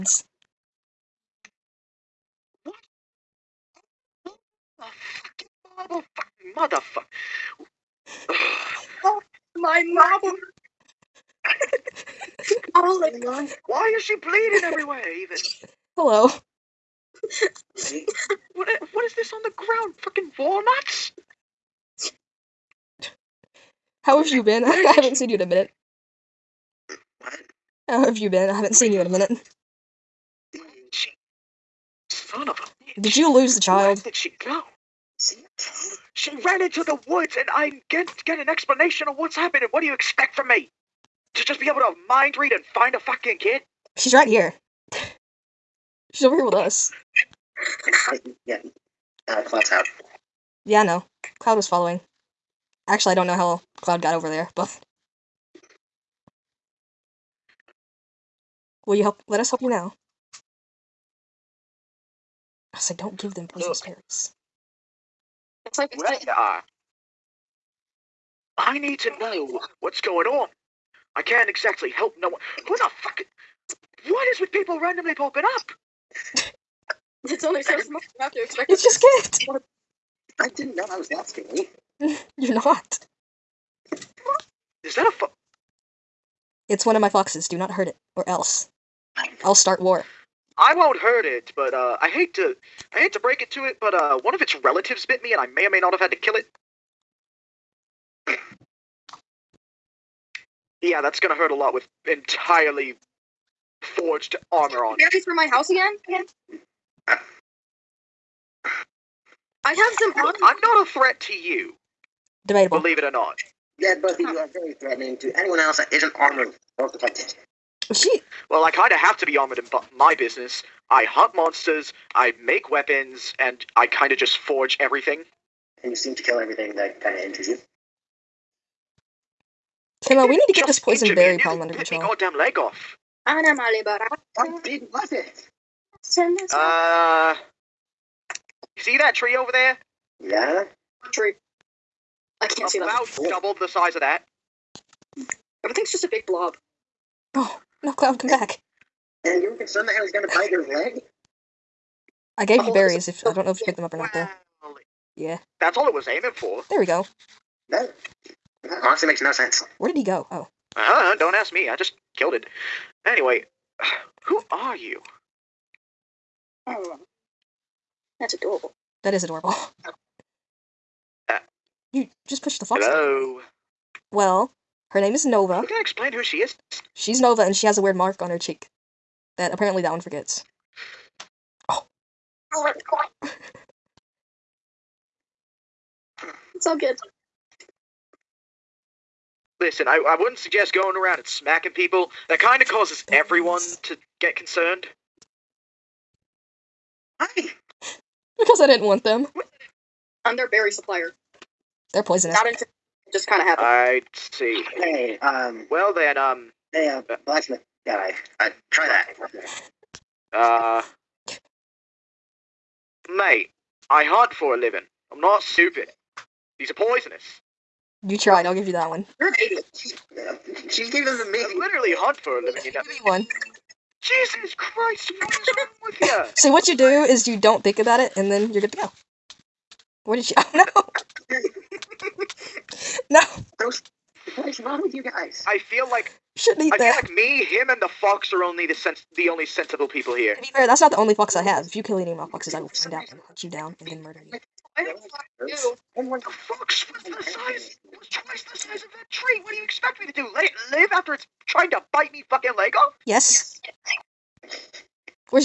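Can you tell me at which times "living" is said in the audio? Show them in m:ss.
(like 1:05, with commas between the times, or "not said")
3:34, 3:42.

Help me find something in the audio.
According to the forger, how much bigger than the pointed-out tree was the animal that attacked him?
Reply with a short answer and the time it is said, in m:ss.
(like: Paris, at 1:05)
Double the size, at 2:23.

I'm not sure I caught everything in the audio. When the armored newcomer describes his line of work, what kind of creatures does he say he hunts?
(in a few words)
Monsters.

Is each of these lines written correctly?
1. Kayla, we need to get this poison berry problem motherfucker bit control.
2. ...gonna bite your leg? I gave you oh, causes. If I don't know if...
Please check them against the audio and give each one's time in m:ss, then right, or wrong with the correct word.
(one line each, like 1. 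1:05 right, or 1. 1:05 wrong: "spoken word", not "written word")
1. 2:10 wrong: "under", not "motherfucker"
2. 2:30 wrong: "berries", not "causes".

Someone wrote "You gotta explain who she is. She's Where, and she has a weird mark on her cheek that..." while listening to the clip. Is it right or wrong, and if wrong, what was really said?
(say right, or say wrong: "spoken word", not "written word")
wrong: "Nova", not "Where".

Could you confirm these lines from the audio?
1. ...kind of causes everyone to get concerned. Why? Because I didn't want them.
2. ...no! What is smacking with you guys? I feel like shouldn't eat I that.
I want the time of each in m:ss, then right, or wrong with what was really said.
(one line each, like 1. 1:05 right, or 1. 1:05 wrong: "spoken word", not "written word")
1. 3:12 right
2. 3:53 wrong: "wrong", not "smacking".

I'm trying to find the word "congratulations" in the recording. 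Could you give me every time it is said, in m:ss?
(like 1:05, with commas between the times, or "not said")
not said.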